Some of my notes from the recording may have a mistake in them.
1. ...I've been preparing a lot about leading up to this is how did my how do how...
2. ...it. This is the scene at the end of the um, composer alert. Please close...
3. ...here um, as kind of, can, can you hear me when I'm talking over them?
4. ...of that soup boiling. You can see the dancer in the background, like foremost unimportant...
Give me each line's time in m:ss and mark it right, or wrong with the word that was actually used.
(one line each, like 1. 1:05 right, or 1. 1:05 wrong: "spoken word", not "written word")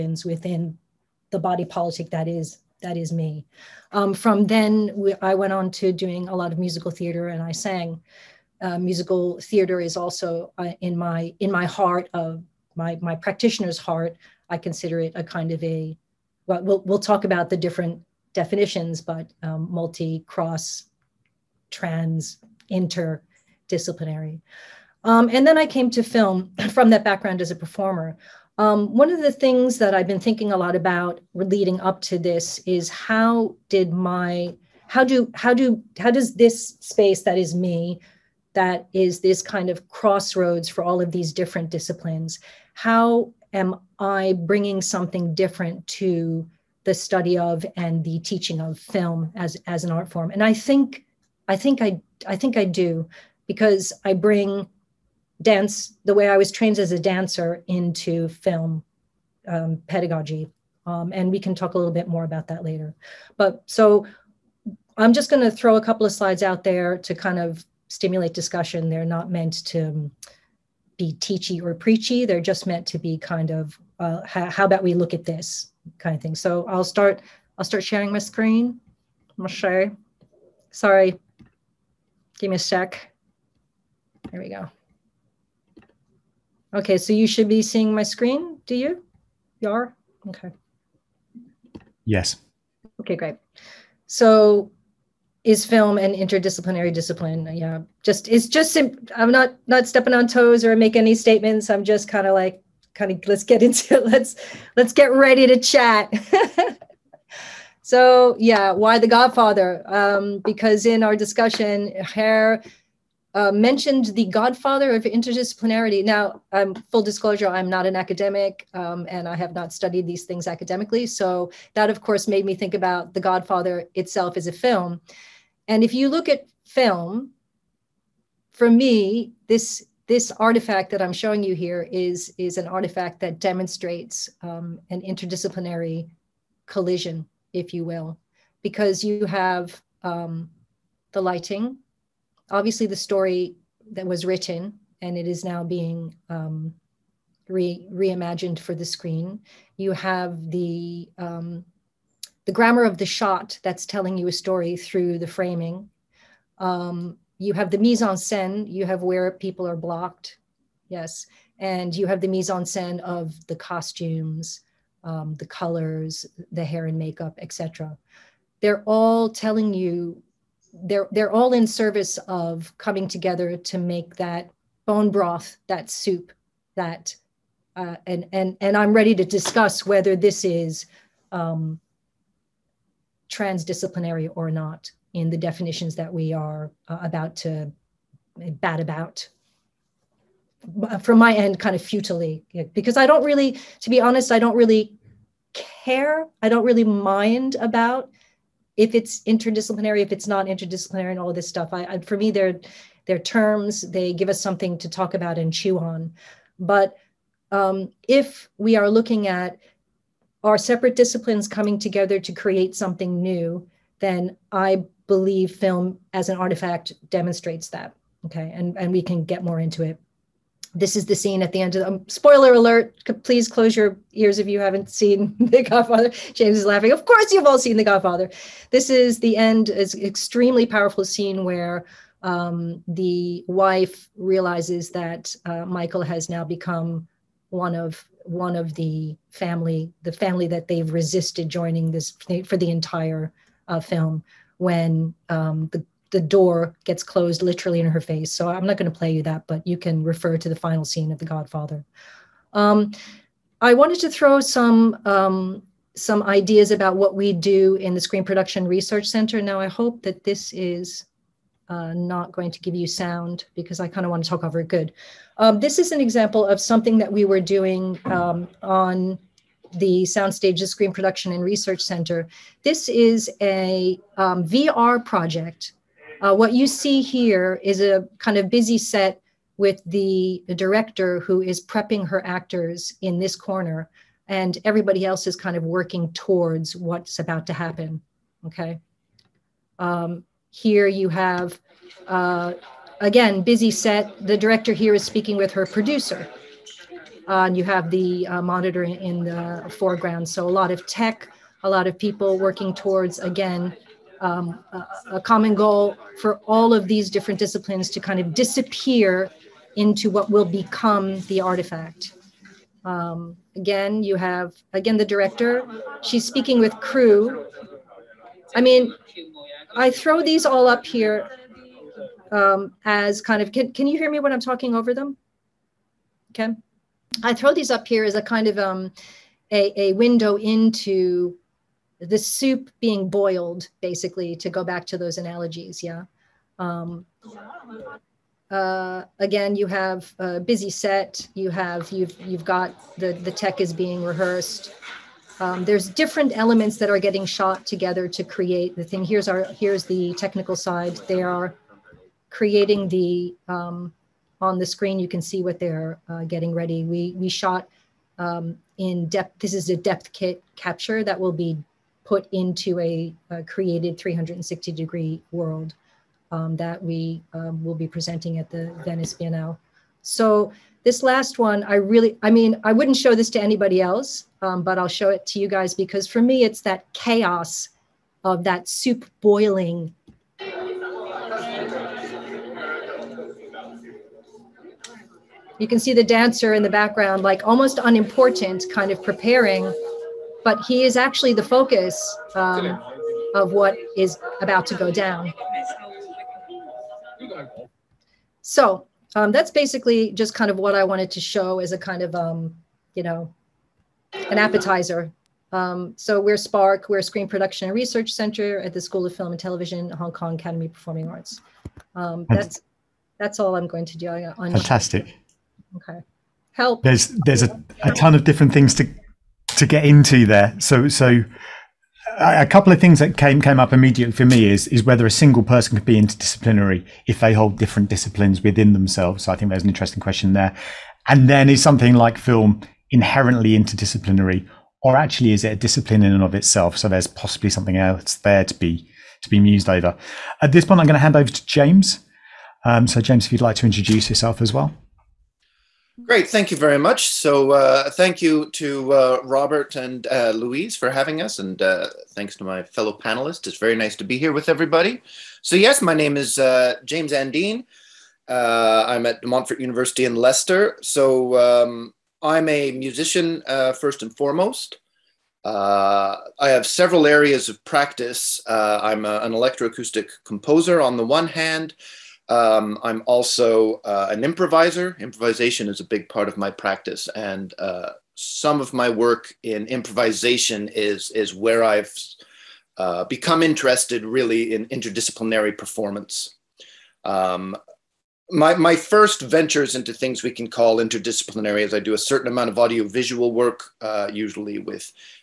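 1. 0:29 wrong: "thinking", not "preparing"
2. 3:39 wrong: "spoiler", not "composer"
3. 5:20 right
4. 6:18 wrong: "almost", not "foremost".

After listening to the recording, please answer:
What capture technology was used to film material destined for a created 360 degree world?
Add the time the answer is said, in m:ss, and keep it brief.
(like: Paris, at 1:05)
Depthkit, at 5:59.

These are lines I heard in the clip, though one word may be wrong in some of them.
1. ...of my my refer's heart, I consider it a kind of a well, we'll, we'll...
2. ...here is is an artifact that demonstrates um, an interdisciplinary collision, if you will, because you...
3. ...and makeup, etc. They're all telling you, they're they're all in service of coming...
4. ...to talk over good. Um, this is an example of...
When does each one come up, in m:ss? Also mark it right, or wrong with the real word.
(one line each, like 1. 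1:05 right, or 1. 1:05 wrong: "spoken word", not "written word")
1. 0:12 wrong: "practitioner", not "refer"
2. 2:11 right
3. 2:46 right
4. 4:24 right.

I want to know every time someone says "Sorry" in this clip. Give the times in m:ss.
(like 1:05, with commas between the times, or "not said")
1:20.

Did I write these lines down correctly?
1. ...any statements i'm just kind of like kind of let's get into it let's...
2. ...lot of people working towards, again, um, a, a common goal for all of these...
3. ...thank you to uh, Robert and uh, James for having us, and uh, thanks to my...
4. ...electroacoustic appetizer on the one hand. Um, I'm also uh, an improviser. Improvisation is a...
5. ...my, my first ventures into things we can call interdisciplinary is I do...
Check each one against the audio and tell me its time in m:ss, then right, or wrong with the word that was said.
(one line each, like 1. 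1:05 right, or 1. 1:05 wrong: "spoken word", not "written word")
1. 1:40 right
2. 5:01 right
3. 7:27 wrong: "Louise", not "James"
4. 7:49 wrong: "composer", not "appetizer"
5. 8:08 right.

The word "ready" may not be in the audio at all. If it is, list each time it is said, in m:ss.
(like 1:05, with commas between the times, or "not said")
1:45, 2:58, 5:56.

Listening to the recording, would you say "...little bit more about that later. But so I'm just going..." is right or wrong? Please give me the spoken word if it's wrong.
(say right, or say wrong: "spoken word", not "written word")
right.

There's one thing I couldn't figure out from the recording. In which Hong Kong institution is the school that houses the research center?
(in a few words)
Hong Kong Academy of Performing Arts.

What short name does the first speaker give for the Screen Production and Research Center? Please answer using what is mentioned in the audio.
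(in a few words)
Spark.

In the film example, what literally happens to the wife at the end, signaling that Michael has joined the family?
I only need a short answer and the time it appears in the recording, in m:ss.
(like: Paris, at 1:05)
door gets closed, at 4:06.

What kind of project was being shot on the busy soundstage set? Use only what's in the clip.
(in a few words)
VR.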